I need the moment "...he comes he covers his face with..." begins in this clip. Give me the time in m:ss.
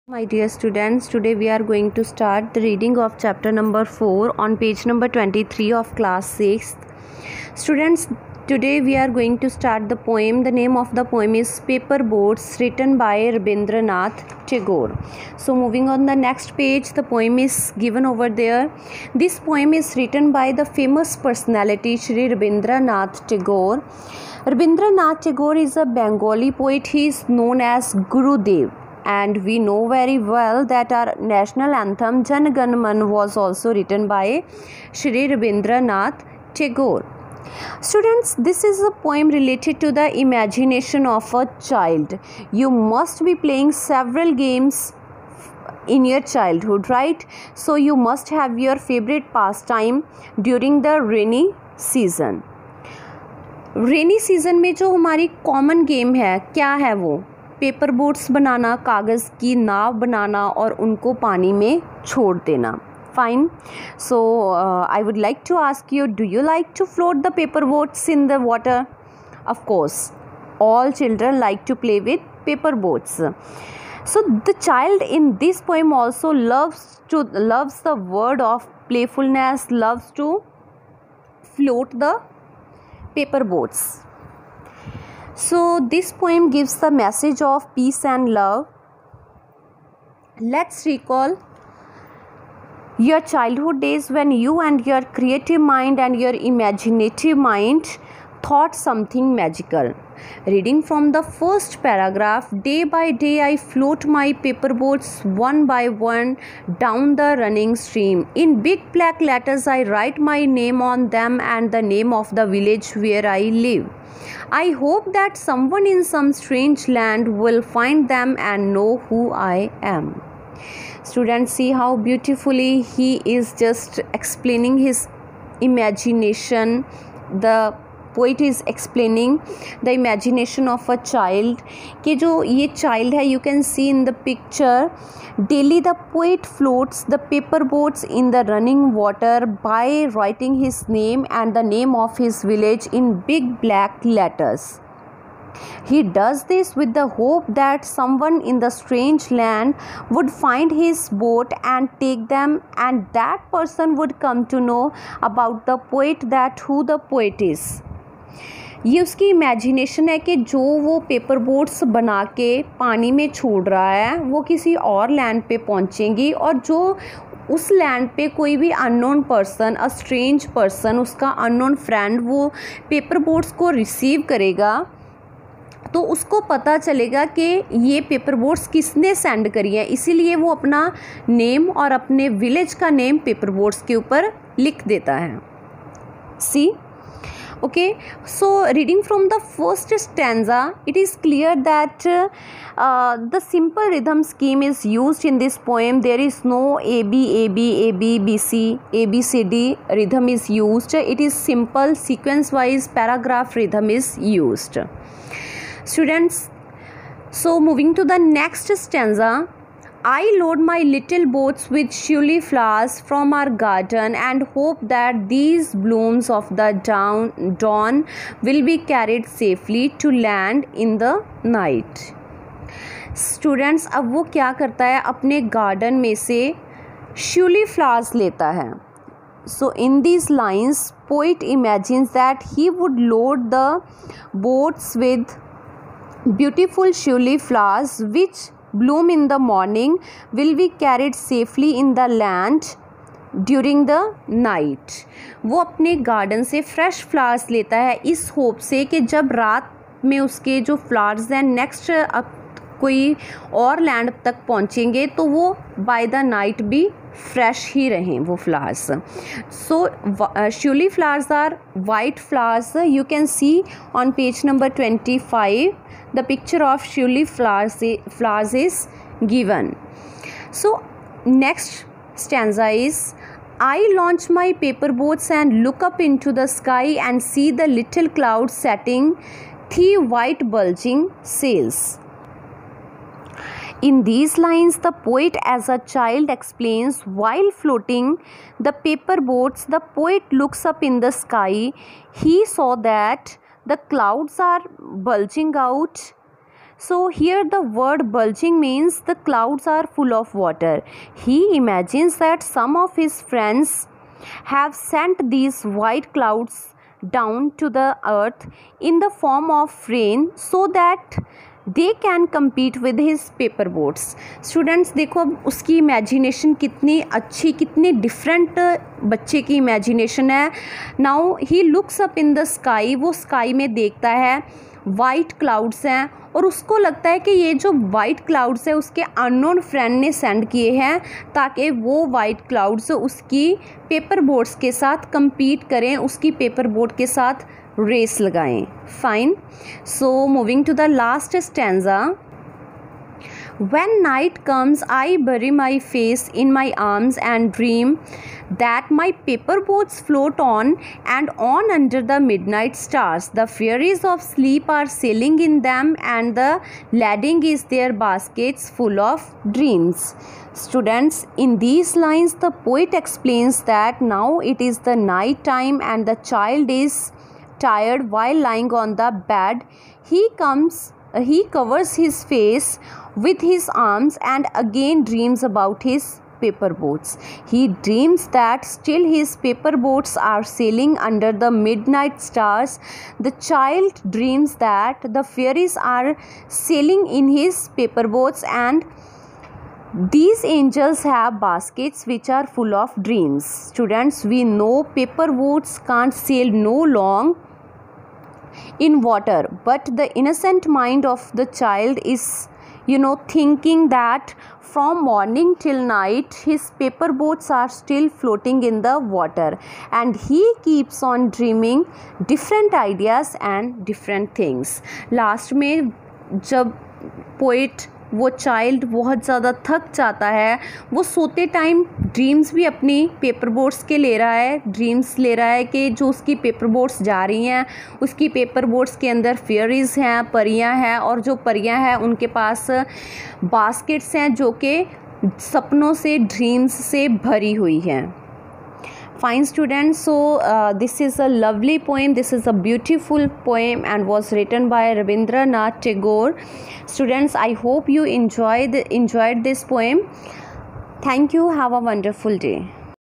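6:10.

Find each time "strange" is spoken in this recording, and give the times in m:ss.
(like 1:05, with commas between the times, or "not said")
1:56, 2:28.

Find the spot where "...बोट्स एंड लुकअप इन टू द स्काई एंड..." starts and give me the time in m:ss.
4:35.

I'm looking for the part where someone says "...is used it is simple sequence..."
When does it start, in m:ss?
3:20.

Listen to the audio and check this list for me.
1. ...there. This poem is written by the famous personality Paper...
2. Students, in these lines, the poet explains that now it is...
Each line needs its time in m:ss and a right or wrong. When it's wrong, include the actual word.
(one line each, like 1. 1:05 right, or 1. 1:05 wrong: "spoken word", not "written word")
1. 0:18 wrong: "Sri", not "Paper"
2. 6:00 right.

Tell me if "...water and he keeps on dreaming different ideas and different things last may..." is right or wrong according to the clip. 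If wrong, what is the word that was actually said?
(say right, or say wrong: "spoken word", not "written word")
right.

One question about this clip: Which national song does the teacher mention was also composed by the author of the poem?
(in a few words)
Jan Gan Man.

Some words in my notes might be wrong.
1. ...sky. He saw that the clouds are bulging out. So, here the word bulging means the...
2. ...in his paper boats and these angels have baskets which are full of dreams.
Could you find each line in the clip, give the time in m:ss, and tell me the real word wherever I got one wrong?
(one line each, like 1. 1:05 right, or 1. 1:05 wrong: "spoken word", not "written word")
1. 4:51 right
2. 6:27 right.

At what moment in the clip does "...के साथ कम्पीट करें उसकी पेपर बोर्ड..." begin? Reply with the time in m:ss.
5:34.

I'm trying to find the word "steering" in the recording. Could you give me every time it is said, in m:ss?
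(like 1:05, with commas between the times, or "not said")
not said.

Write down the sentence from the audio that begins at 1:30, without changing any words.
Let's recall your childhood days when you and your creative mind and your imaginative mind thought something magical.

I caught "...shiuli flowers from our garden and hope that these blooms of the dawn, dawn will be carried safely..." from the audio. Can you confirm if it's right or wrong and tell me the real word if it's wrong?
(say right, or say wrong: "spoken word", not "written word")
right.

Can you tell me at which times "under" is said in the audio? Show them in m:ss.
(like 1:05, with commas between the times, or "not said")
5:51, 6:20.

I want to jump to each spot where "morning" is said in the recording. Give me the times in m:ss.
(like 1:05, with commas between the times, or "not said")
3:59, 6:45.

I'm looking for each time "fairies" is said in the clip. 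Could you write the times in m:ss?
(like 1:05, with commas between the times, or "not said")
5:53, 6:25.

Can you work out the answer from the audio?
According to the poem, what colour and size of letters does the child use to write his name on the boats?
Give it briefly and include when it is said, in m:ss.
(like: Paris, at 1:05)
big black letters, at 1:48.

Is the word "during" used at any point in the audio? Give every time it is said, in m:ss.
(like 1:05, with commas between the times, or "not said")
0:50, 4:03.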